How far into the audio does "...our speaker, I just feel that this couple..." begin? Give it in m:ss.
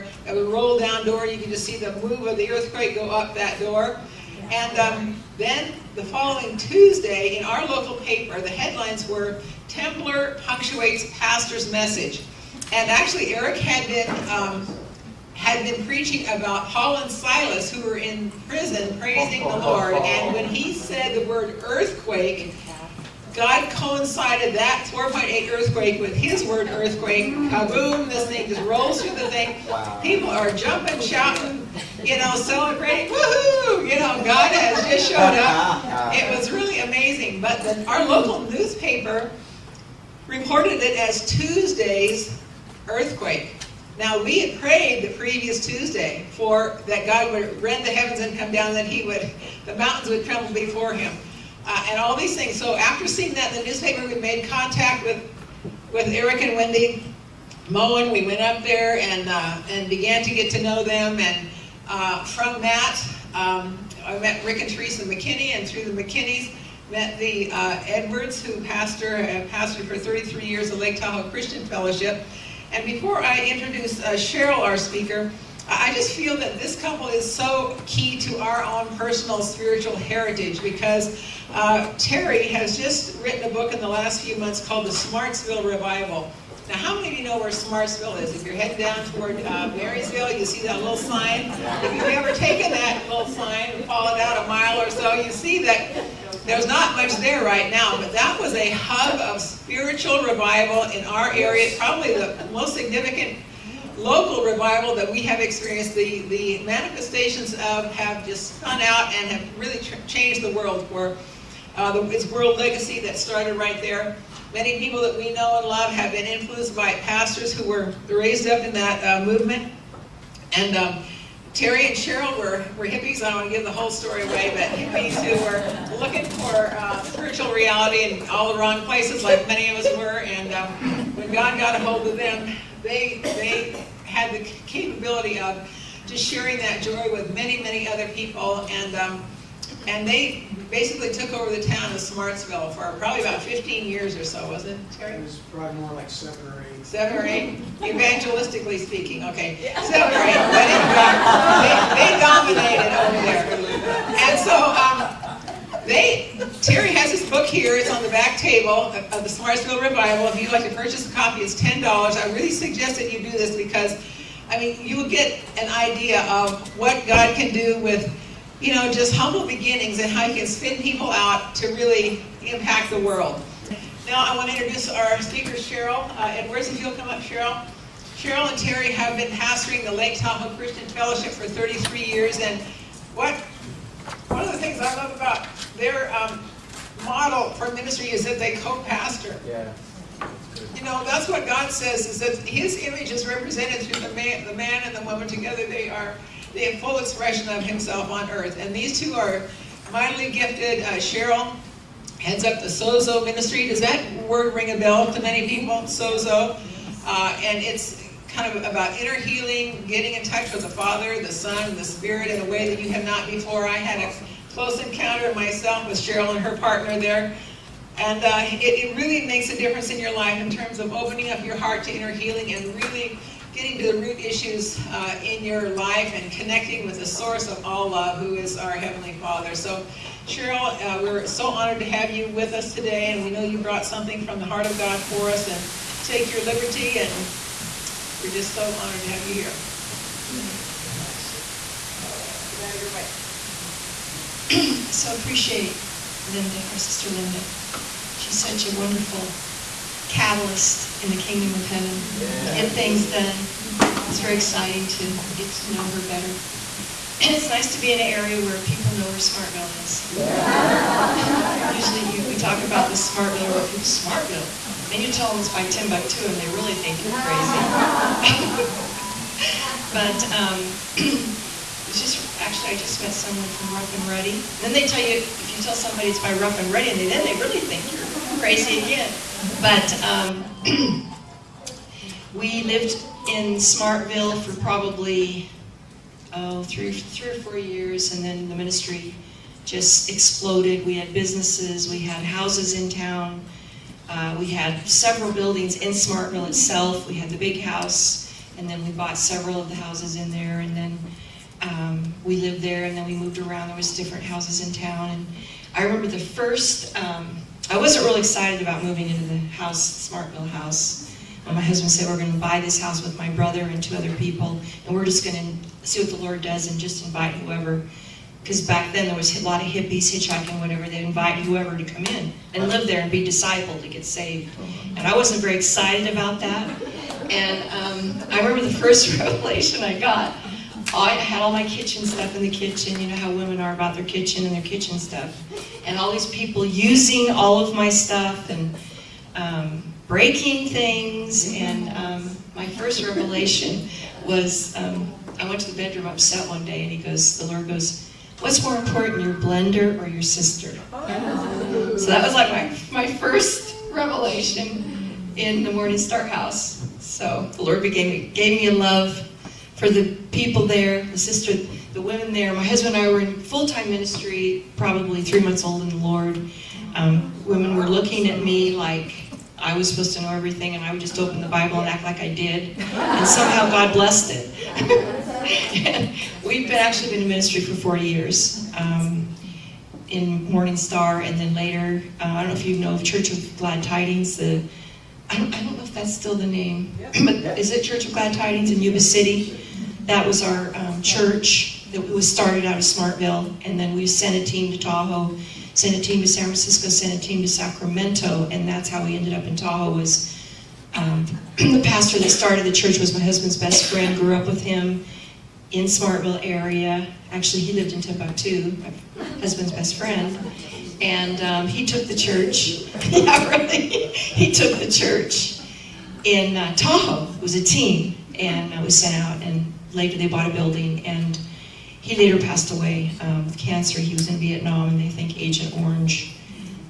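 1:14.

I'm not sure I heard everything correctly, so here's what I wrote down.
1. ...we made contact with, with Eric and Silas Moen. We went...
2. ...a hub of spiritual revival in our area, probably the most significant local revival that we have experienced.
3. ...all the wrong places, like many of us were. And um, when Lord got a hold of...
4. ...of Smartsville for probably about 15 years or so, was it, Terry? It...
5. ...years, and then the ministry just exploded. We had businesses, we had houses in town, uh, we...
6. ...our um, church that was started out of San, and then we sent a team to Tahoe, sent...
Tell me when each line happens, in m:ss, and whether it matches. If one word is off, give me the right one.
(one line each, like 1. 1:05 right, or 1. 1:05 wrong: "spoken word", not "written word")
1. 0:54 wrong: "Wendy", not "Silas"
2. 1:38 right
3. 2:08 wrong: "God", not "Lord"
4. 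2:21 right
5. 4:47 right
6. 6:30 wrong: "Smartville", not "San".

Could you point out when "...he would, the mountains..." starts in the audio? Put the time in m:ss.
0:48.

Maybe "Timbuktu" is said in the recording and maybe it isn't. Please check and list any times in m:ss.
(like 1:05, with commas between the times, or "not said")
4:25, 6:48.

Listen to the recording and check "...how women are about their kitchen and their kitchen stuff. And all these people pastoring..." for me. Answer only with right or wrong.
wrong.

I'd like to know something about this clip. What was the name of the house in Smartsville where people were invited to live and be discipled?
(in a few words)
Morning Star House.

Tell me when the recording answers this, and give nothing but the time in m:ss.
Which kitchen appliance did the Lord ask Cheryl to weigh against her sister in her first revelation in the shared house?
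5:49.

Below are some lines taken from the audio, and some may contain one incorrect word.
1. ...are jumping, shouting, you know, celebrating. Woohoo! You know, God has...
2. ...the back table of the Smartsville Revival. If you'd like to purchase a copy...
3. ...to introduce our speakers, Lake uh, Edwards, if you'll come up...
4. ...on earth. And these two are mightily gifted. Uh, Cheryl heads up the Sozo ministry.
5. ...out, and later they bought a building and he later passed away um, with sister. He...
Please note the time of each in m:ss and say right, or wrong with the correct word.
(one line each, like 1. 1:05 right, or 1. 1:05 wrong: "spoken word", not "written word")
1. 0:30 right
2. 2:38 right
3. 2:54 wrong: "Cheryl", not "Lake"
4. 3:18 right
5. 6:59 wrong: "cancer", not "sister".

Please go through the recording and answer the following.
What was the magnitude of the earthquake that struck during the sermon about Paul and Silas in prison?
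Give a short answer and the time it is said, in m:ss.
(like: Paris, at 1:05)
4.8, at 0:24.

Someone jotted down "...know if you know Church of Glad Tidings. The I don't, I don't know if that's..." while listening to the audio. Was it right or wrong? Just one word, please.
right.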